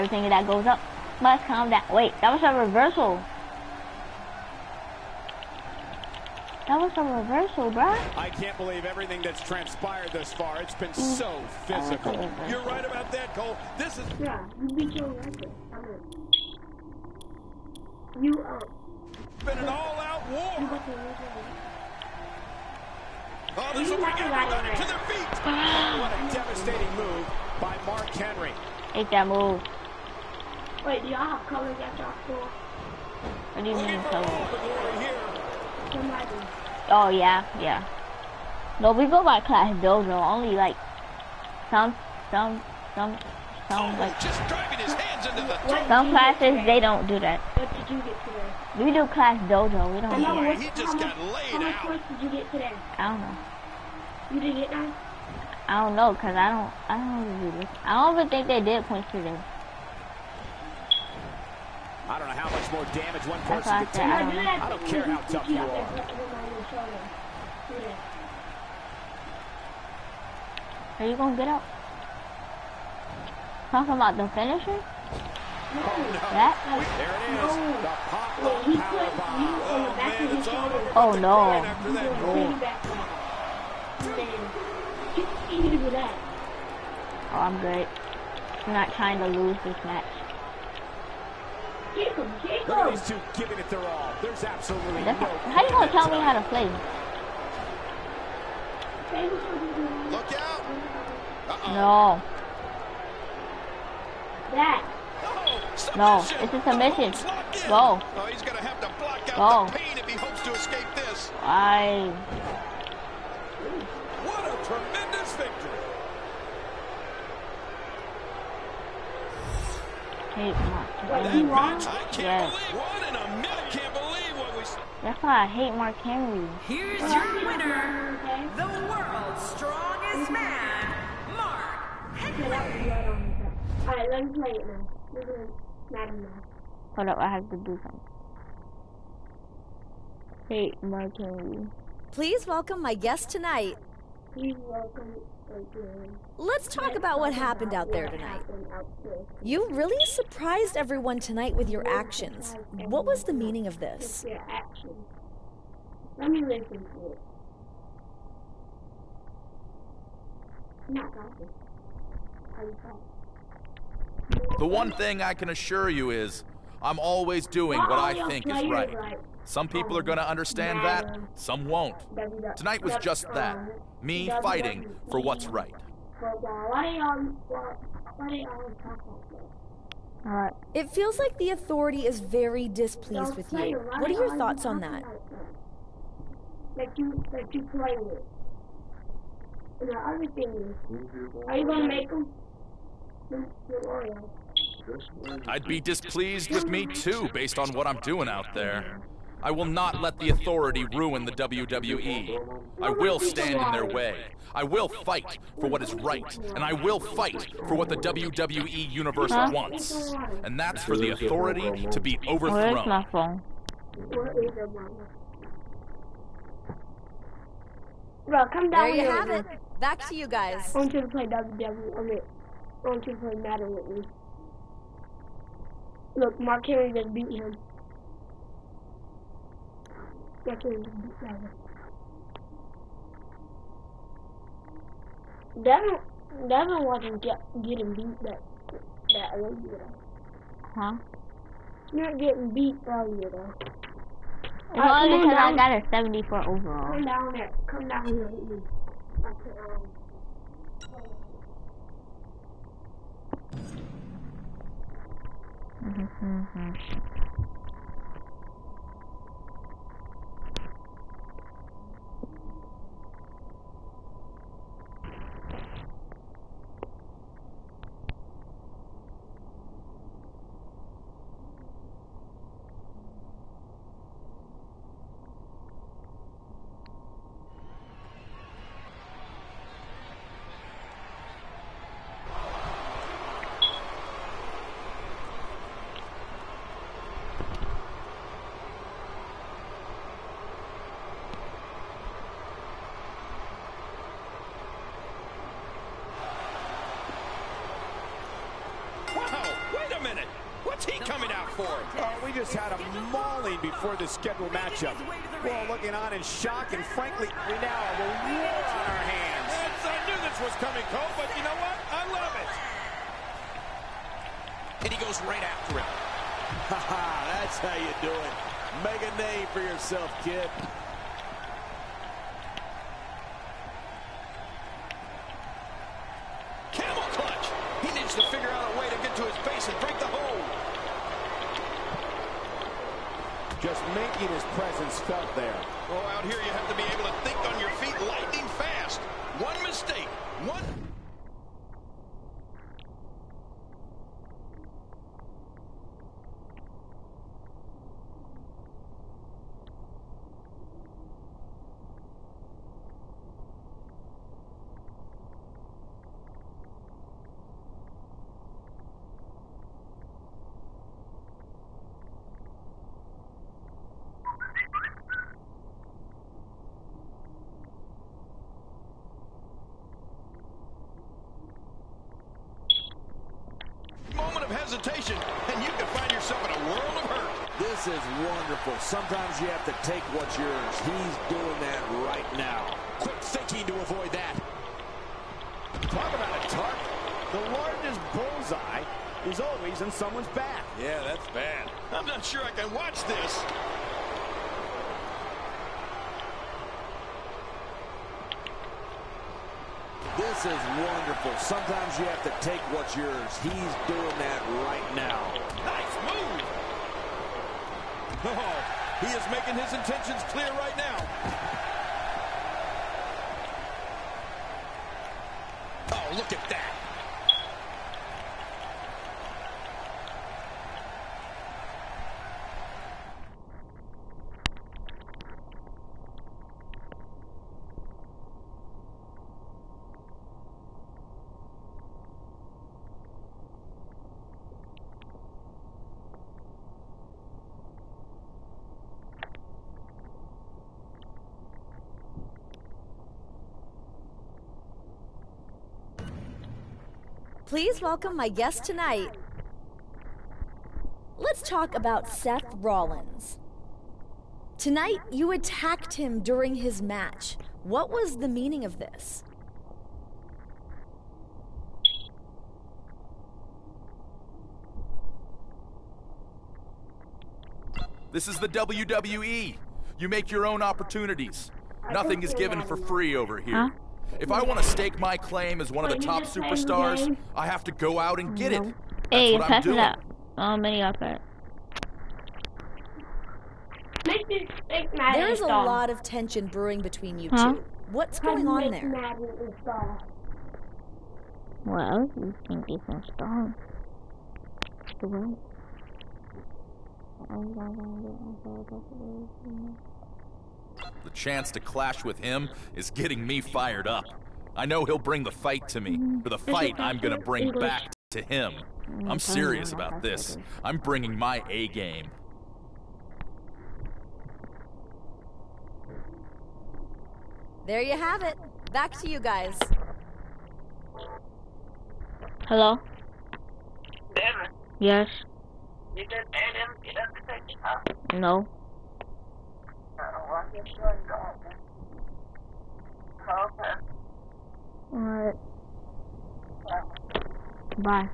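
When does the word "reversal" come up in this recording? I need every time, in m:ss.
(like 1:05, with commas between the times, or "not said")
0:02, 0:07.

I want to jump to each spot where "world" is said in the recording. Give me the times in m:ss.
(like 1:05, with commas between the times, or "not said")
2:08, 6:16.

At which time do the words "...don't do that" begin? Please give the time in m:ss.
0:46.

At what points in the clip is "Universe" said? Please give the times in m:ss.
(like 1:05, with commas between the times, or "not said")
3:28.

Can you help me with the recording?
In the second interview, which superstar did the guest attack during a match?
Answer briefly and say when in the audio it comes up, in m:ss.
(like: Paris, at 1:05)
Seth Rollins, at 7:32.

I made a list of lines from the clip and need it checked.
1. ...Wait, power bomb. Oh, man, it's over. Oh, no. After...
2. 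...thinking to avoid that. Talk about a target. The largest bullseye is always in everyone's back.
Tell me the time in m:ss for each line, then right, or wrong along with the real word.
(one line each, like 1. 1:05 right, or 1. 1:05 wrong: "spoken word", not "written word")
1. 1:18 right
2. 6:23 wrong: "someone", not "everyone".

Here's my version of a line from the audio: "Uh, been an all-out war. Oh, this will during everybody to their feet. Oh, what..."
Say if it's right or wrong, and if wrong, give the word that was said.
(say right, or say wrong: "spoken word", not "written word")
wrong: "bring", not "during".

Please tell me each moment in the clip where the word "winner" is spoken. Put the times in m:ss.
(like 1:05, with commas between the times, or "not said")
2:07.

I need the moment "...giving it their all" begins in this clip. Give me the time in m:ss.
1:33.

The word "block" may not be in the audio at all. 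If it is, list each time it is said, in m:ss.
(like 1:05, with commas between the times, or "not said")
1:49.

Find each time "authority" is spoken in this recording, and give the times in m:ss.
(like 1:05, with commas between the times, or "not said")
3:01, 3:20, 3:31.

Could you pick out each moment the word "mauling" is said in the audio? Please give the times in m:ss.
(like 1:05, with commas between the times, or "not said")
5:03.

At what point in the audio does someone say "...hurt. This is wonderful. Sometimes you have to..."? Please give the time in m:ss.
6:17.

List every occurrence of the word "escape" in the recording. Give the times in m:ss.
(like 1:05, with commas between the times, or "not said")
1:50.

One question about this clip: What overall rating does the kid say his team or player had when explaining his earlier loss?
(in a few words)
74.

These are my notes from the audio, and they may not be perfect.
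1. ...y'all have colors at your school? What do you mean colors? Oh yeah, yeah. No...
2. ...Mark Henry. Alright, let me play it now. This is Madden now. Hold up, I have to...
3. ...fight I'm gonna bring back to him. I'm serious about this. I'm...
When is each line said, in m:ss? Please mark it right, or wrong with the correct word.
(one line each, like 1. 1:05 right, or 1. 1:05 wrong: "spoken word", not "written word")
1. 0:31 right
2. 2:11 right
3. 8:26 right.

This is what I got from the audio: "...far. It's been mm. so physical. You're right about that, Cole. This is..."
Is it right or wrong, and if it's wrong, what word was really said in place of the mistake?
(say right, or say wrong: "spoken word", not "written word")
right.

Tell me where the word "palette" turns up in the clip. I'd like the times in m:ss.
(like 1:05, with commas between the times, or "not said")
not said.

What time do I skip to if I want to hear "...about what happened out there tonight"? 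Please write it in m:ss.
2:26.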